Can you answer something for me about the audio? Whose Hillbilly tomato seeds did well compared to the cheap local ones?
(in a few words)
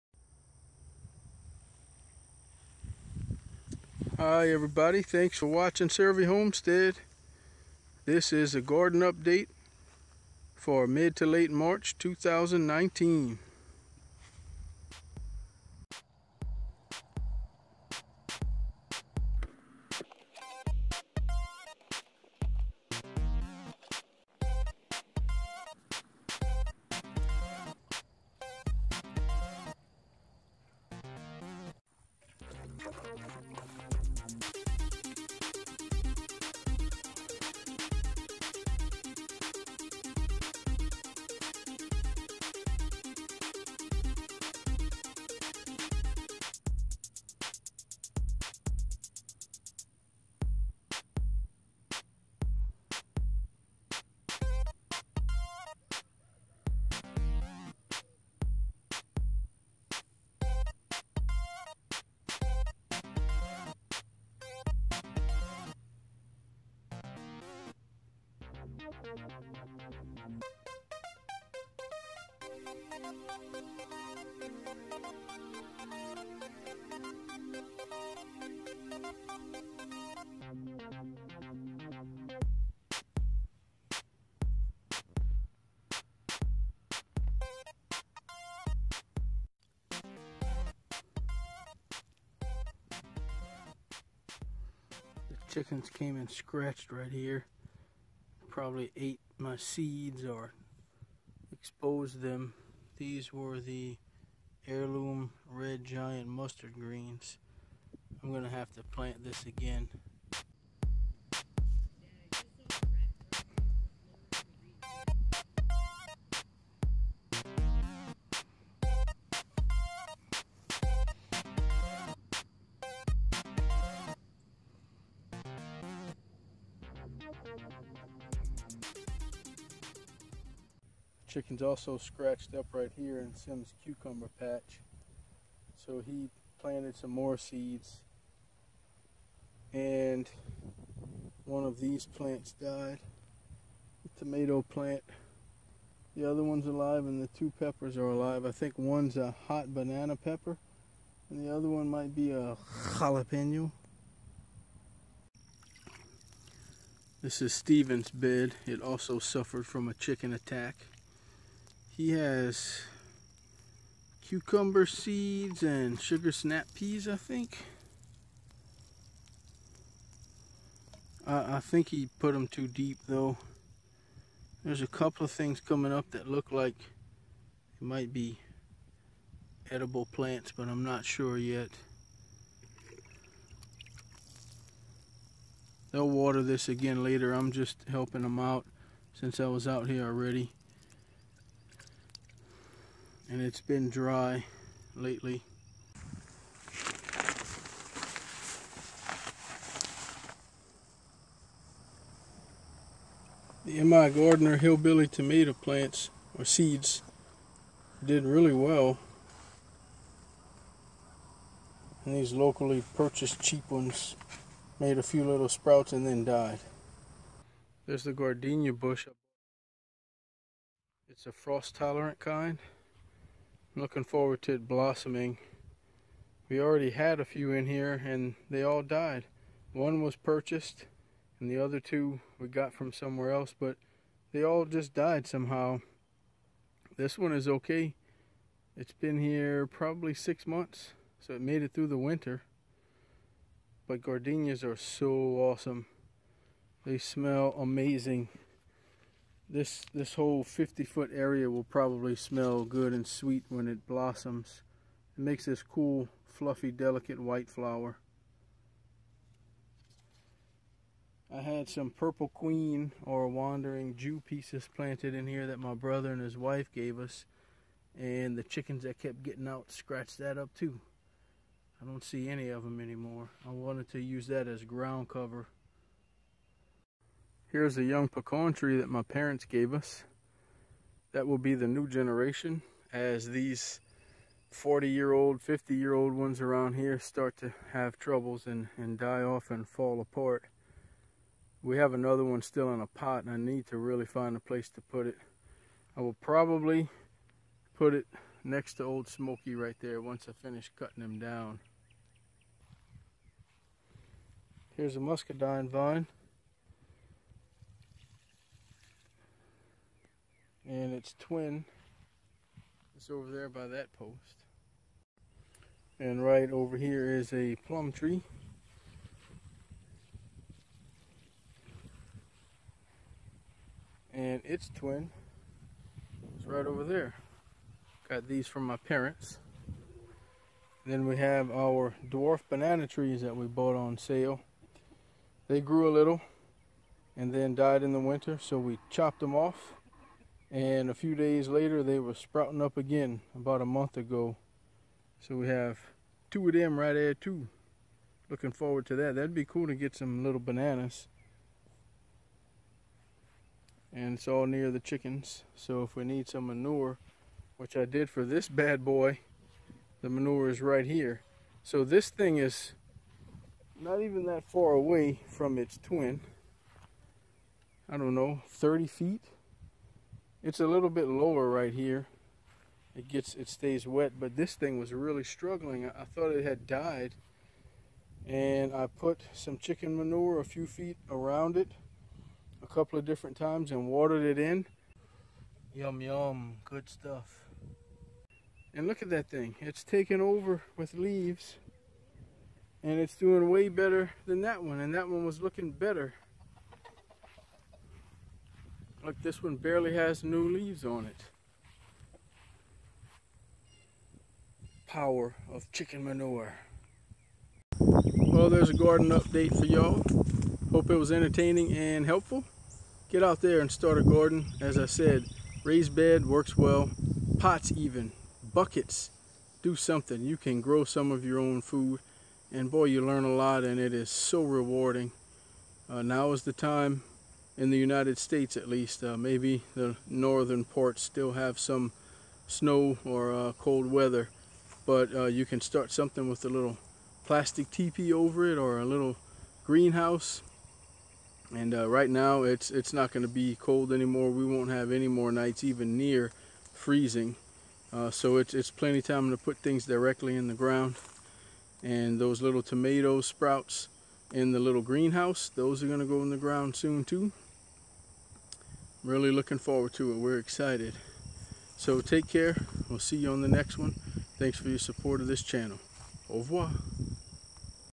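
MI Gardener.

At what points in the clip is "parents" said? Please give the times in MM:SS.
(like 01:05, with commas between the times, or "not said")
04:39, 05:28.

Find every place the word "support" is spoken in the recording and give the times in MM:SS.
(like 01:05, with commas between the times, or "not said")
07:44.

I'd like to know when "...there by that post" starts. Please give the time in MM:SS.
05:13.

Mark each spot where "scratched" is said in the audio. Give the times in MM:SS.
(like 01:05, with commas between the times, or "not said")
01:36, 02:11, 04:29.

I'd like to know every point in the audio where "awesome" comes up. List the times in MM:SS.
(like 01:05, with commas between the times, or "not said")
04:05.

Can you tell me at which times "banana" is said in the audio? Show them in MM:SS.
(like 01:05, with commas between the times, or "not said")
02:29, 05:32, 05:50.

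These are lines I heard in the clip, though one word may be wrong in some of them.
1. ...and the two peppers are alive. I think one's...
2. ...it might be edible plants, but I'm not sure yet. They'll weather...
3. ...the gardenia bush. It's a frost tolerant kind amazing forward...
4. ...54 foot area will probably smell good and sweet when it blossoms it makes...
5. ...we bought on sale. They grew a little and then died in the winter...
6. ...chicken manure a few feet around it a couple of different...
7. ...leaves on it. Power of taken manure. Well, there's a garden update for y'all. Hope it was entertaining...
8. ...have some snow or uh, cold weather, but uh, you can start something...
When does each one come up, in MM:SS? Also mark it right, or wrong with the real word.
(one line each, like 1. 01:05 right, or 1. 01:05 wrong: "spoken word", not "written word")
1. 02:27 right
2. 02:56 wrong: "water", not "weather"
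3. 03:38 wrong: "looking", not "amazing"
4. 04:10 wrong: "50", not "54"
5. 05:33 right
6. 06:19 right
7. 06:40 wrong: "chicken", not "taken"
8. 07:11 right.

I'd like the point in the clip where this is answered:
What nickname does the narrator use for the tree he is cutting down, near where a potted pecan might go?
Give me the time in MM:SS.
04:58.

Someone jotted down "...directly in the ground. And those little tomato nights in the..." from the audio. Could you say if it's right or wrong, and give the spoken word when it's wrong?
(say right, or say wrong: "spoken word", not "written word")
wrong: "sprouts", not "nights".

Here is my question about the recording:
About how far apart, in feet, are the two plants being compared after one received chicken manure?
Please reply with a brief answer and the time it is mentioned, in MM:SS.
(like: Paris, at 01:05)
30 feet, at 06:08.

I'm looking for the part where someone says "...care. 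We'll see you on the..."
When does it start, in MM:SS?
07:42.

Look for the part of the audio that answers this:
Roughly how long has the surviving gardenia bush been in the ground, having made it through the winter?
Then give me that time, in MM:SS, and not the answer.
04:00.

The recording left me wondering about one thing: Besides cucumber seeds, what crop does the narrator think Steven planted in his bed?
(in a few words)
Sugar snap peas.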